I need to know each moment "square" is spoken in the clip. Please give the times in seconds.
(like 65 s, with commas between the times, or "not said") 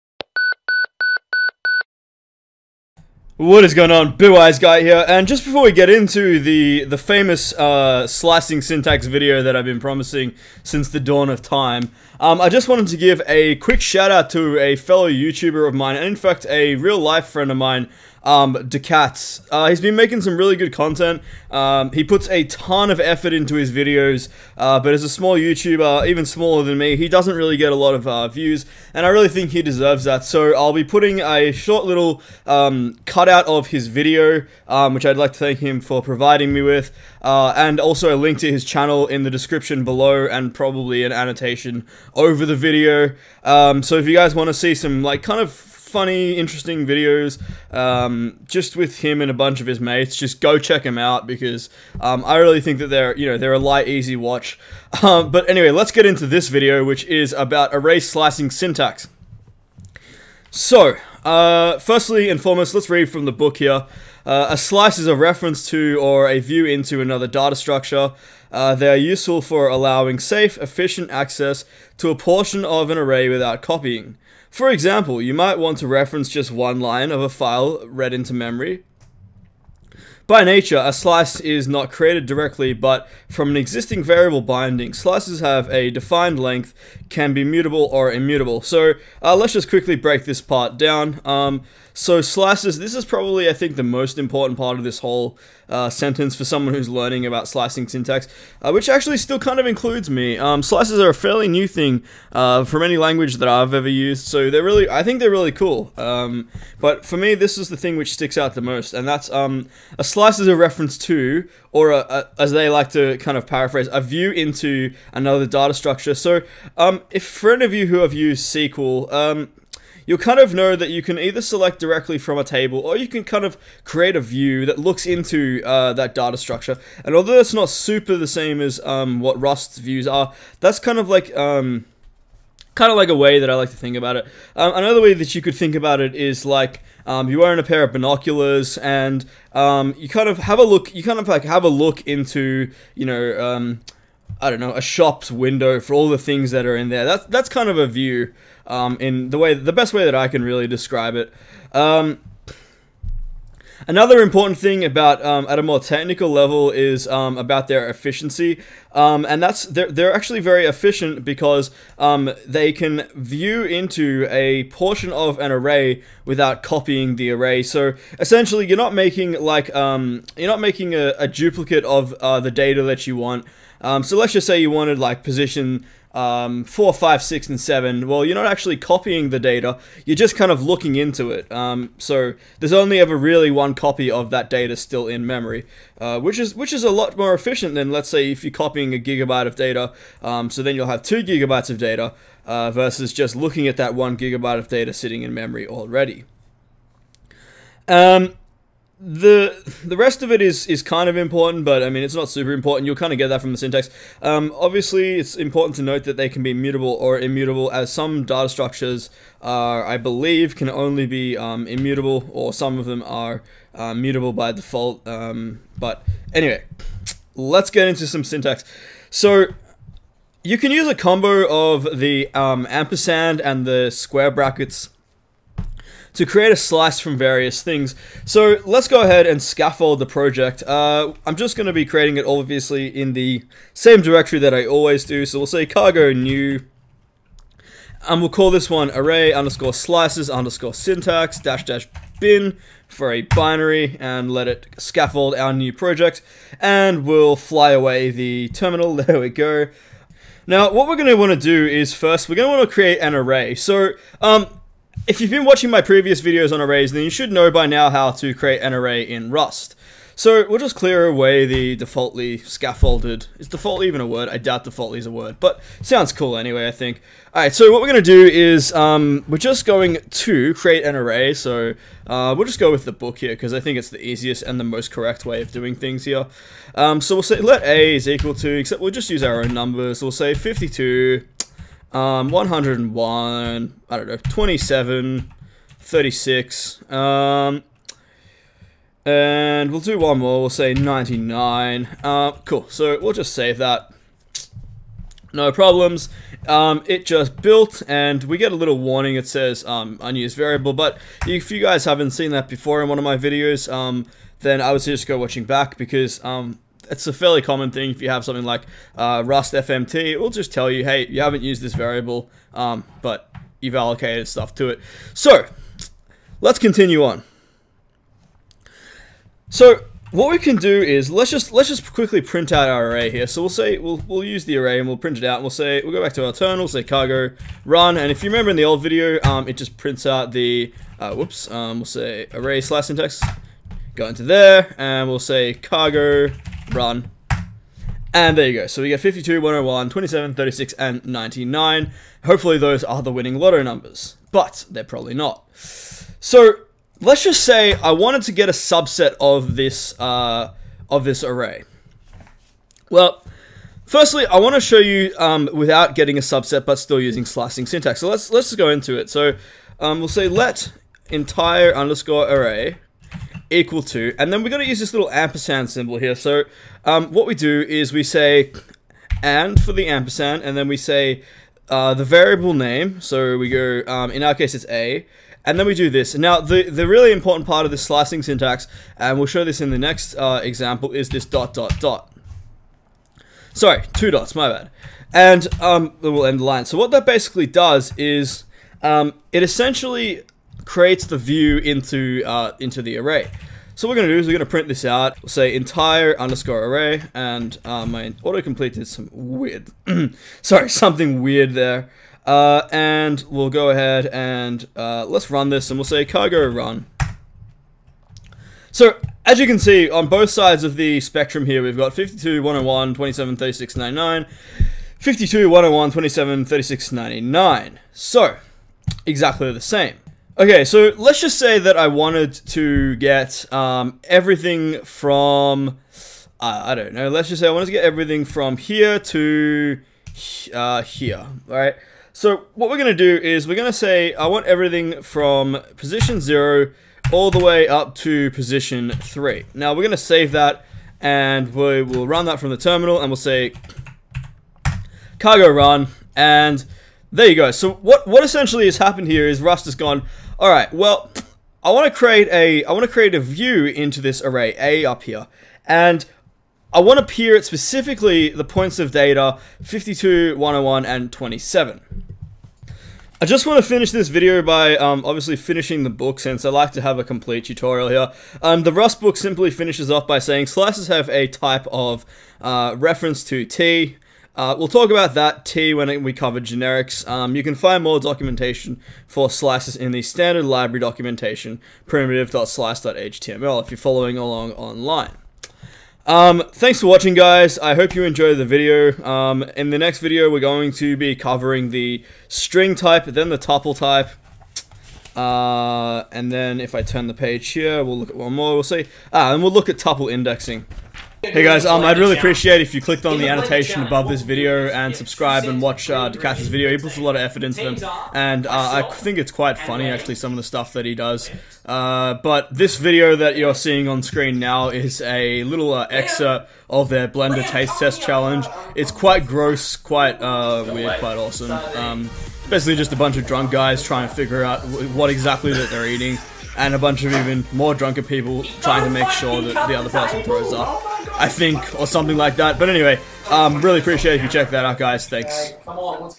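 223 s.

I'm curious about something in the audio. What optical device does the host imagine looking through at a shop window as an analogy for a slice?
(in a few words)
binoculars.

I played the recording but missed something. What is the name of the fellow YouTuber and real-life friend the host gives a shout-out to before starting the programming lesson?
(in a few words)
DaKatz.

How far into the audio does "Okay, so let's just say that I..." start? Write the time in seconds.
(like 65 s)
420 s.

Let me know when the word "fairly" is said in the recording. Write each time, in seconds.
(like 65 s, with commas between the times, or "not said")
101 s, 307 s.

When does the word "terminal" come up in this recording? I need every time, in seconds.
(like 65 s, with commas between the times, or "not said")
248 s, 326 s, 442 s.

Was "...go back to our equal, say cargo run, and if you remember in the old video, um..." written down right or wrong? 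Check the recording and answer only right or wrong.
wrong.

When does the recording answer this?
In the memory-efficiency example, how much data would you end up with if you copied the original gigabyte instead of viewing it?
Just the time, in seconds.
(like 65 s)
191 s.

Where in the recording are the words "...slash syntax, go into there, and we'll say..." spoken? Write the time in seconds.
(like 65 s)
332 s.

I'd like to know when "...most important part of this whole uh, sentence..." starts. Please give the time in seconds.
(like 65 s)
93 s.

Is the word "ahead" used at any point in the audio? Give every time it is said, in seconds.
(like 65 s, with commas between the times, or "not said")
229 s, 403 s.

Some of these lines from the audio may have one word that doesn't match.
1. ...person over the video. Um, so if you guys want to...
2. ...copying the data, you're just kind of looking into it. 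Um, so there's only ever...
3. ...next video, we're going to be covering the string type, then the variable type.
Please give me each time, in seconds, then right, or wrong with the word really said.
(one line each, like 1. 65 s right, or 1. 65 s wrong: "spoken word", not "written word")
1. 41 s wrong: "annotation", not "person"
2. 178 s right
3. 489 s wrong: "tuple", not "variable".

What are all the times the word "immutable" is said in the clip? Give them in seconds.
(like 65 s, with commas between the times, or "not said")
88 s, 207 s, 211 s.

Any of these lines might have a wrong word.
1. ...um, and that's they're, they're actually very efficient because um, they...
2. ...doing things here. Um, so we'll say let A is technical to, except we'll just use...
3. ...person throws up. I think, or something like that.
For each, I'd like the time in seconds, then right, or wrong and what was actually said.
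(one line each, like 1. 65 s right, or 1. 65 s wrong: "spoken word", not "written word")
1. 158 s right
2. 275 s wrong: "equal", not "technical"
3. 529 s right.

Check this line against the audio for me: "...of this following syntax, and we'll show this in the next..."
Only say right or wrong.
wrong.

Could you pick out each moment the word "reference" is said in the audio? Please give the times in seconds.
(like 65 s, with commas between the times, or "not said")
65 s, 75 s, 110 s, 472 s.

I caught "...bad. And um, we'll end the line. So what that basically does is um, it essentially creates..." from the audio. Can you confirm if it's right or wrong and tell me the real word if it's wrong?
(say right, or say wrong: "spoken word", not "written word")
right.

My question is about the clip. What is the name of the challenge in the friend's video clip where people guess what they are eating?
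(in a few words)
Blender Taste Test Challenge.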